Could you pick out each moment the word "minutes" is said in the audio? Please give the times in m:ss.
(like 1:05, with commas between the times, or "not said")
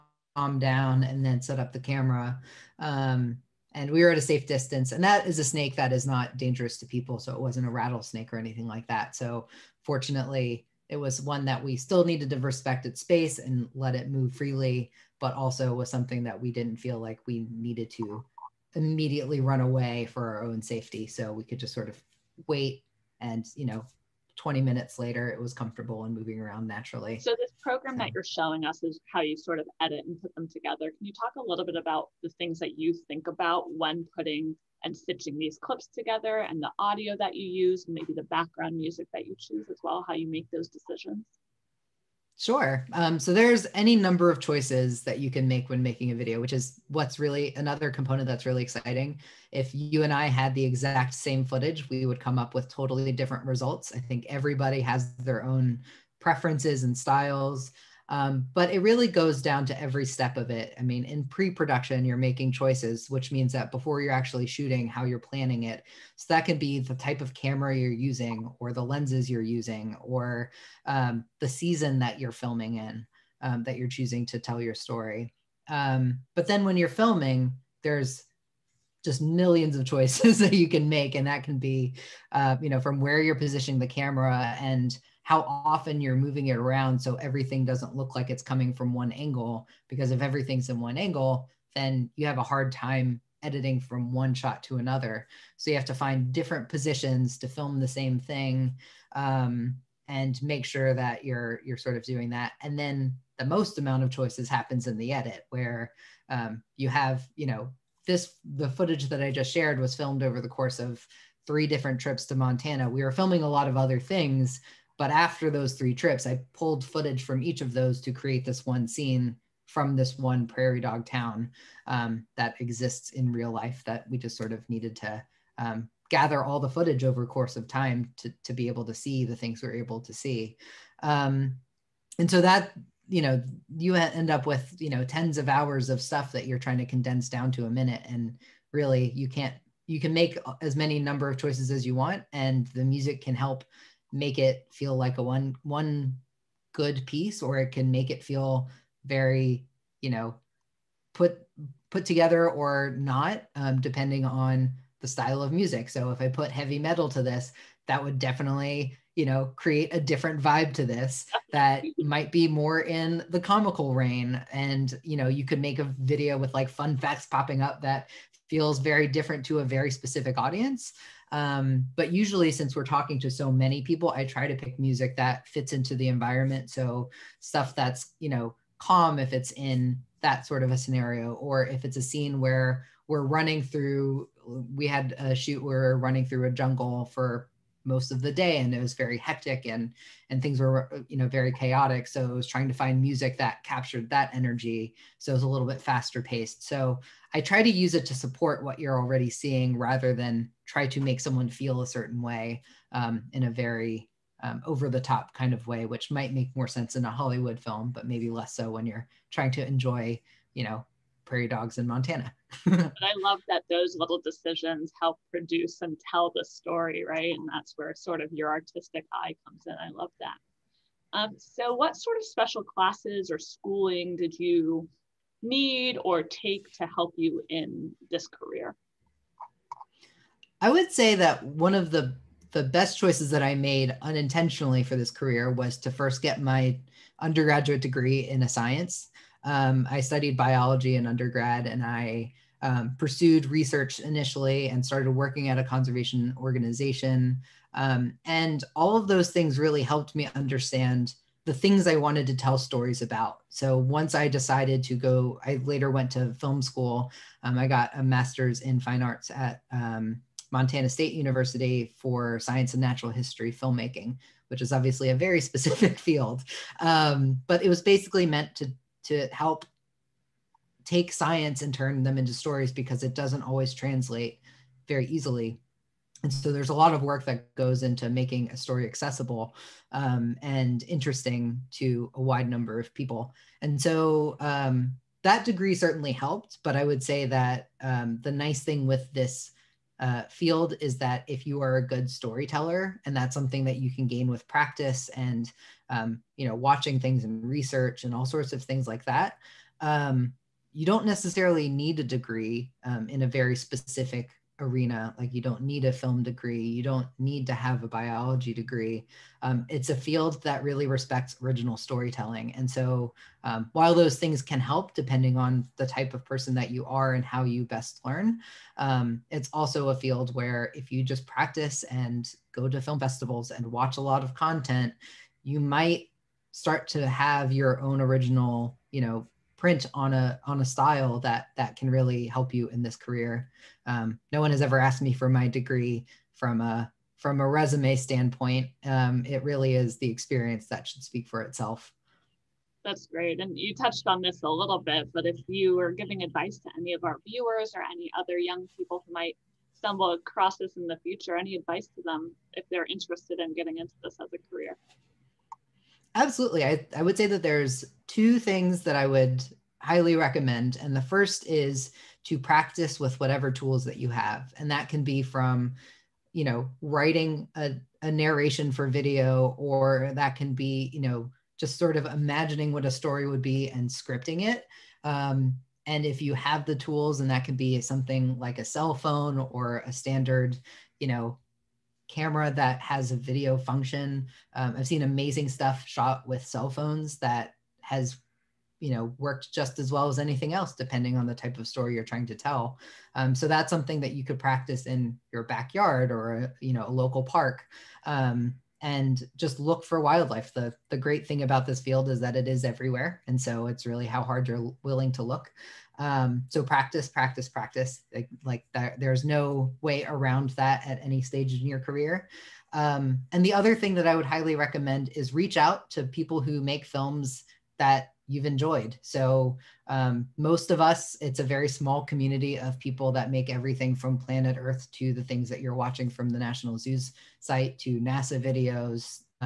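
0:24, 2:17.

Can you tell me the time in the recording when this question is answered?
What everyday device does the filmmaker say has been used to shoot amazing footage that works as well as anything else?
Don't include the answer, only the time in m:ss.
6:26.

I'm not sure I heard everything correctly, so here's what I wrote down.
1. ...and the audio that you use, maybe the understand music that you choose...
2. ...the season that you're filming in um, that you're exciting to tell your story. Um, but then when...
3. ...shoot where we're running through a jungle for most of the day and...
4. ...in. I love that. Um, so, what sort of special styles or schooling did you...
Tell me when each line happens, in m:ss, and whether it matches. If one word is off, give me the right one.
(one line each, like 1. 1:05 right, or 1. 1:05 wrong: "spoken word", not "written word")
1. 0:36 wrong: "background", not "understand"
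2. 1:11 wrong: "choosing", not "exciting"
3. 3:05 right
4. 3:39 wrong: "classes", not "styles".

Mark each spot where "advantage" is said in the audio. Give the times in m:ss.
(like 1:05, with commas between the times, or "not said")
not said.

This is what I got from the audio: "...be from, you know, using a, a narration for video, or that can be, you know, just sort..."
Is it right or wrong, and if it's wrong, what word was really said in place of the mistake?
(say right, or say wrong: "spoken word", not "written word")
wrong: "writing", not "using".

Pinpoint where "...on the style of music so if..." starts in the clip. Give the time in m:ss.
2:34.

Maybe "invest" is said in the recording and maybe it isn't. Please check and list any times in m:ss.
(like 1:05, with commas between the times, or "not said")
not said.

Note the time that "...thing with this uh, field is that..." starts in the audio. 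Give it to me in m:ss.
4:48.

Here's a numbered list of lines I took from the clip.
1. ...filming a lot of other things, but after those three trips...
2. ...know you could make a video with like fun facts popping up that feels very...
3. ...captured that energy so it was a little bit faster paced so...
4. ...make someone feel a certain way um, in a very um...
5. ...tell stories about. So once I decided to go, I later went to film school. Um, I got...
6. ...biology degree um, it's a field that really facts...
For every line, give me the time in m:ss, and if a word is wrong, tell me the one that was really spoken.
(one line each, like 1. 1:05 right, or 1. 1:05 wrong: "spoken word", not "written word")
1. 1:53 right
2. 2:45 right
3. 3:13 right
4. 3:21 right
5. 4:12 right
6. 5:07 wrong: "respects", not "facts".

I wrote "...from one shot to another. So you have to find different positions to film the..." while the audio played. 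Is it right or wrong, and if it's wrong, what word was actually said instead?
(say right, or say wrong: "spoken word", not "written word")
right.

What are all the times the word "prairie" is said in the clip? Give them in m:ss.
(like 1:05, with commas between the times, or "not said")
2:00, 3:31.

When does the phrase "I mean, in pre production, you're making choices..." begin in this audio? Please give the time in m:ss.
1:00.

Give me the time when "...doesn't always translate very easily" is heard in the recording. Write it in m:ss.
4:33.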